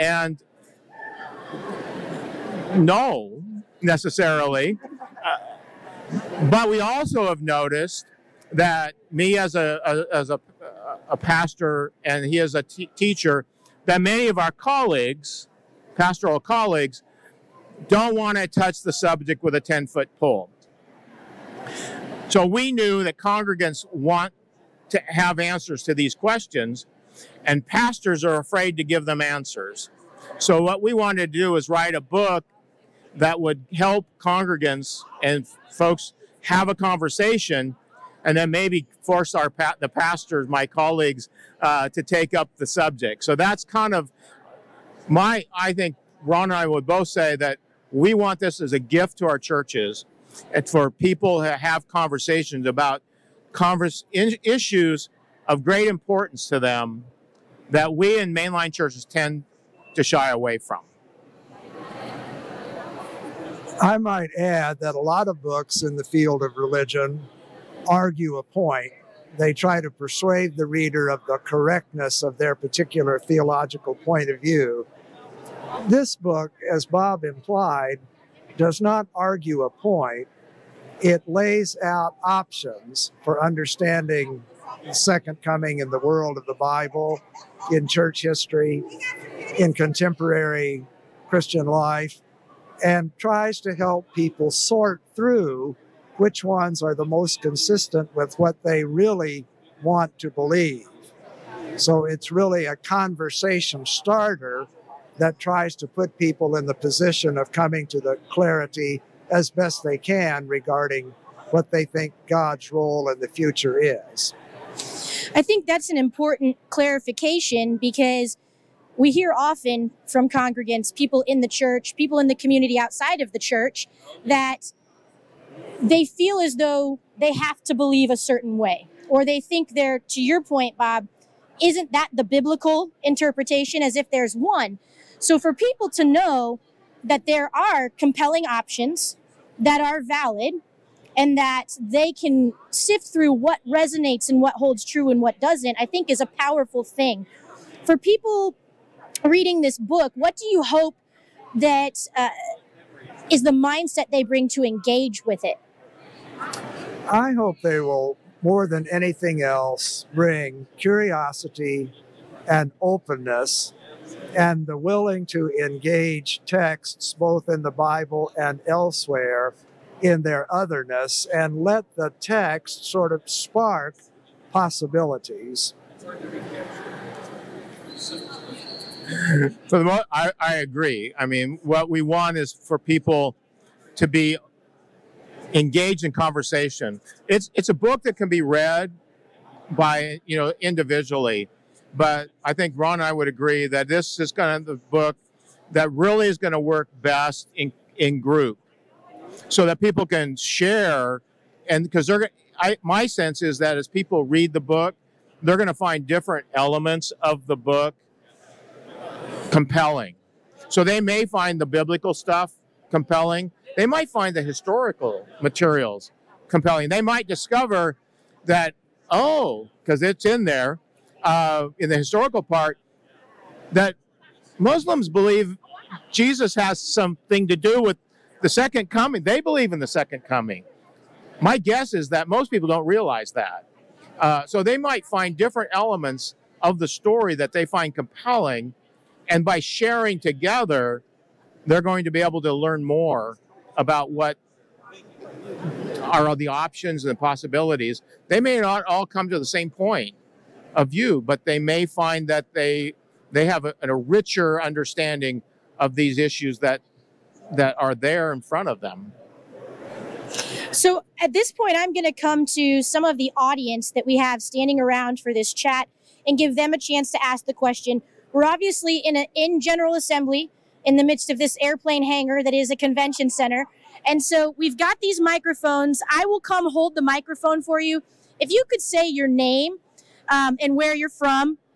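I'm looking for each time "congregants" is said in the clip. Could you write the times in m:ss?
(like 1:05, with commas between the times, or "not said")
0:23, 0:34, 2:00.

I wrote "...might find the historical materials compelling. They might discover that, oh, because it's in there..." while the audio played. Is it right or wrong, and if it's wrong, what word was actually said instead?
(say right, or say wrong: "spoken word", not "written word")
right.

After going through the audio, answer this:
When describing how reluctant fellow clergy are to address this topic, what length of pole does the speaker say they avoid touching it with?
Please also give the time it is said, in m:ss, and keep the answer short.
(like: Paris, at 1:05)
10 foot, at 0:19.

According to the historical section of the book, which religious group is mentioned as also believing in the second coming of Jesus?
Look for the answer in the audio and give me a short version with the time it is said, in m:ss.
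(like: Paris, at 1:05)
Muslims, at 3:44.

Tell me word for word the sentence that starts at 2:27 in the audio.
For people reading this book, what do you hope that uh, is the mindset they bring to engage with it?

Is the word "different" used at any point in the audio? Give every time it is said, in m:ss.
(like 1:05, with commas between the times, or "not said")
3:26, 3:55.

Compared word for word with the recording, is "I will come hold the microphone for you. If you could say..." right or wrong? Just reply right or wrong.
right.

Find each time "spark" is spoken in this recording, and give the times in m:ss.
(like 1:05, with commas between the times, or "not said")
2:53.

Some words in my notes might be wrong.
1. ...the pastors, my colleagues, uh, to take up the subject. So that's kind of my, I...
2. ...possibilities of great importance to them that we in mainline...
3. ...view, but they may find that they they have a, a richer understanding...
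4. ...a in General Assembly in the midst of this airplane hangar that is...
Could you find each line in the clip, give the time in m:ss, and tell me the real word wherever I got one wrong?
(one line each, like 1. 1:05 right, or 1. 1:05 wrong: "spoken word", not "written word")
1. 0:39 right
2. 0:54 wrong: "issues", not "possibilities"
3. 4:10 right
4. 4:29 right.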